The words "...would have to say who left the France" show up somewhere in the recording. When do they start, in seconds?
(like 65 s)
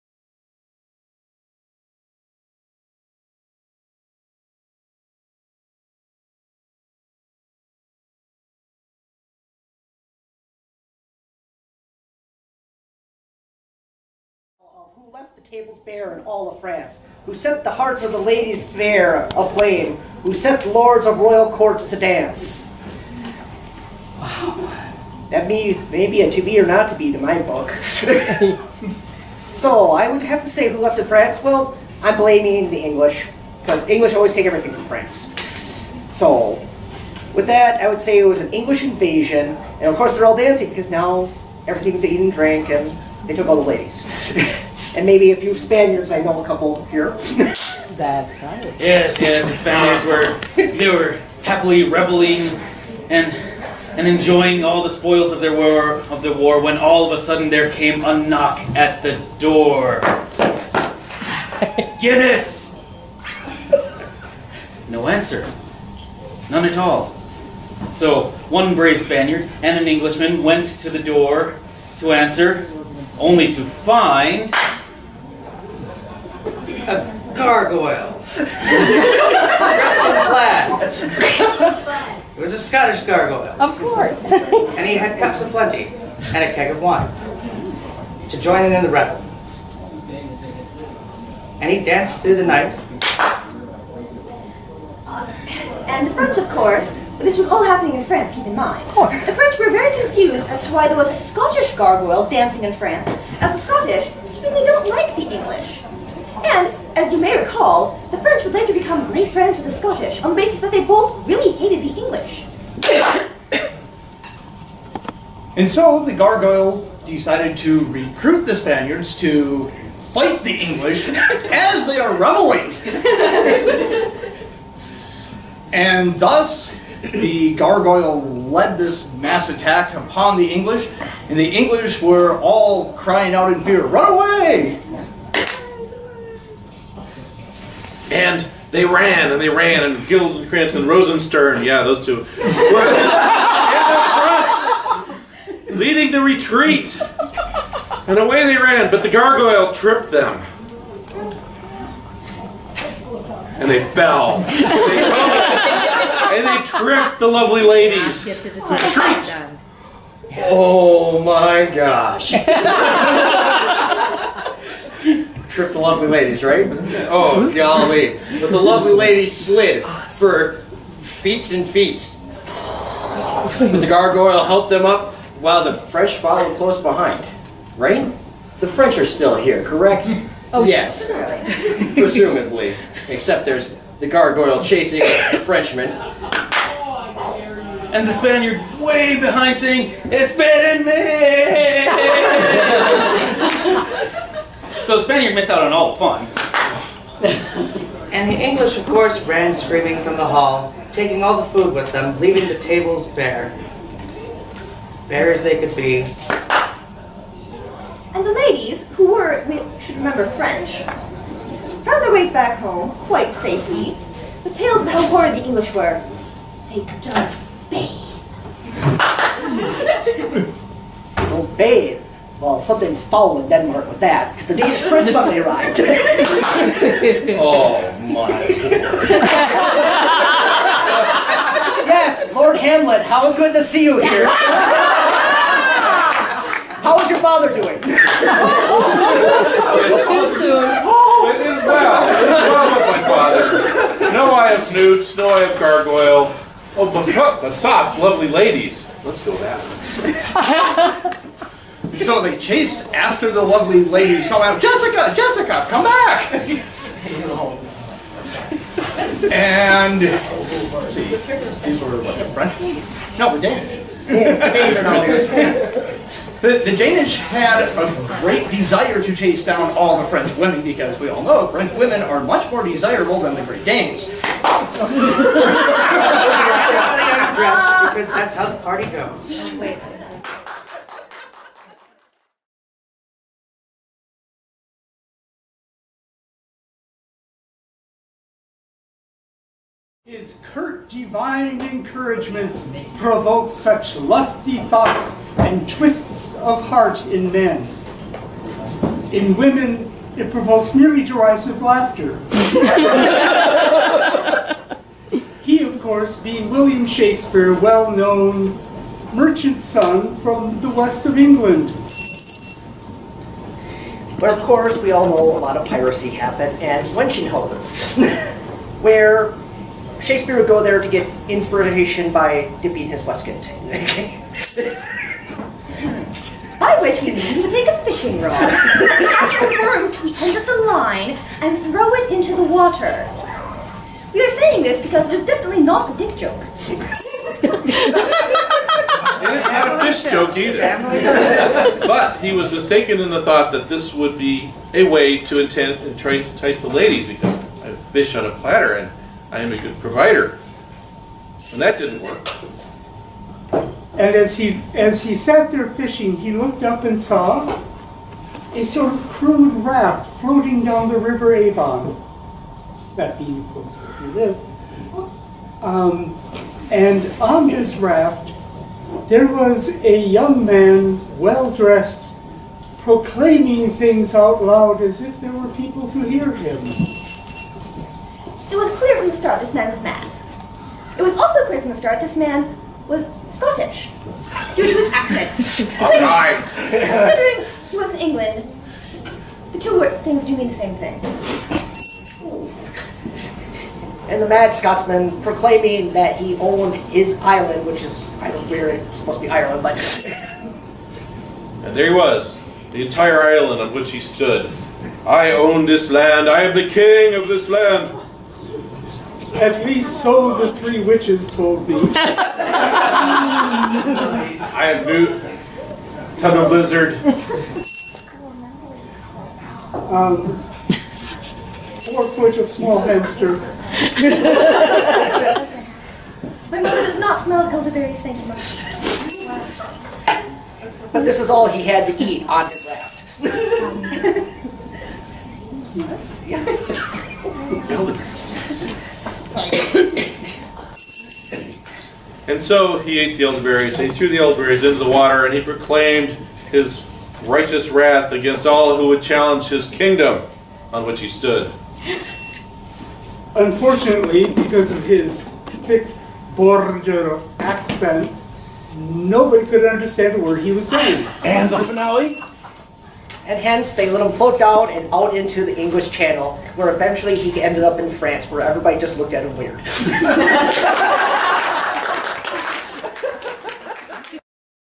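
30 s.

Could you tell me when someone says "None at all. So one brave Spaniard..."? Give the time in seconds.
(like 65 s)
66 s.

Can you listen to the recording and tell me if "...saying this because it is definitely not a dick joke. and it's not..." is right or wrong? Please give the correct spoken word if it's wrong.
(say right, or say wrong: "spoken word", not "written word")
right.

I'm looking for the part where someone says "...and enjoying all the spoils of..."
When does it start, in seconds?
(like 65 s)
53 s.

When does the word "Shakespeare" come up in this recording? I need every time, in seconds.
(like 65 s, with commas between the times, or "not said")
306 s, 320 s.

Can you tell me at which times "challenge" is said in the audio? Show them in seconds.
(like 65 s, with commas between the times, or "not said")
449 s.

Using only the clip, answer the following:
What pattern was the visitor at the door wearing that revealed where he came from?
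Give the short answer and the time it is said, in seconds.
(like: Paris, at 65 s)
Plaid, at 78 s.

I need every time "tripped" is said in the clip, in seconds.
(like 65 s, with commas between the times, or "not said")
149 s, 156 s, 165 s.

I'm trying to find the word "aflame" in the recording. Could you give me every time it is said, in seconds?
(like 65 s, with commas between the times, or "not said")
19 s.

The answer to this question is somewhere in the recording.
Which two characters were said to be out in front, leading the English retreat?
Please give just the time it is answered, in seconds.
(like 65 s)
140 s.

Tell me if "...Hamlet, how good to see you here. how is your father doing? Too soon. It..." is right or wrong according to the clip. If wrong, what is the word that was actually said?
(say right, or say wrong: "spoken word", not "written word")
right.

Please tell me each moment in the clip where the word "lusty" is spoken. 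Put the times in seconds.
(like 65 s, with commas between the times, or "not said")
293 s.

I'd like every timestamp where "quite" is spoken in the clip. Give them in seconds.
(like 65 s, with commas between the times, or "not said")
213 s.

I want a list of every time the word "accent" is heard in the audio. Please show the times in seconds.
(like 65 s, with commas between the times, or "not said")
384 s, 457 s.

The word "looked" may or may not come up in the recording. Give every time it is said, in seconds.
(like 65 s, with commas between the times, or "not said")
356 s, 468 s.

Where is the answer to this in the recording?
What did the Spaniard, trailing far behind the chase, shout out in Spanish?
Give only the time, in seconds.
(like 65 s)
190 s.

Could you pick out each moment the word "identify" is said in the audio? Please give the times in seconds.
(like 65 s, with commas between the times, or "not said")
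not said.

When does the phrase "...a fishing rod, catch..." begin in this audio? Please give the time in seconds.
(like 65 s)
327 s.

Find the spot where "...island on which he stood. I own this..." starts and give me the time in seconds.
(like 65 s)
403 s.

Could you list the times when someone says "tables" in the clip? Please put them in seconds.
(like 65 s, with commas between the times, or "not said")
15 s, 202 s.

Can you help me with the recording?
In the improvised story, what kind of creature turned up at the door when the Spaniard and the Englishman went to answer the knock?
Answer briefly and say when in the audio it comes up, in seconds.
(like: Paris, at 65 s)
A gargoyle, at 76 s.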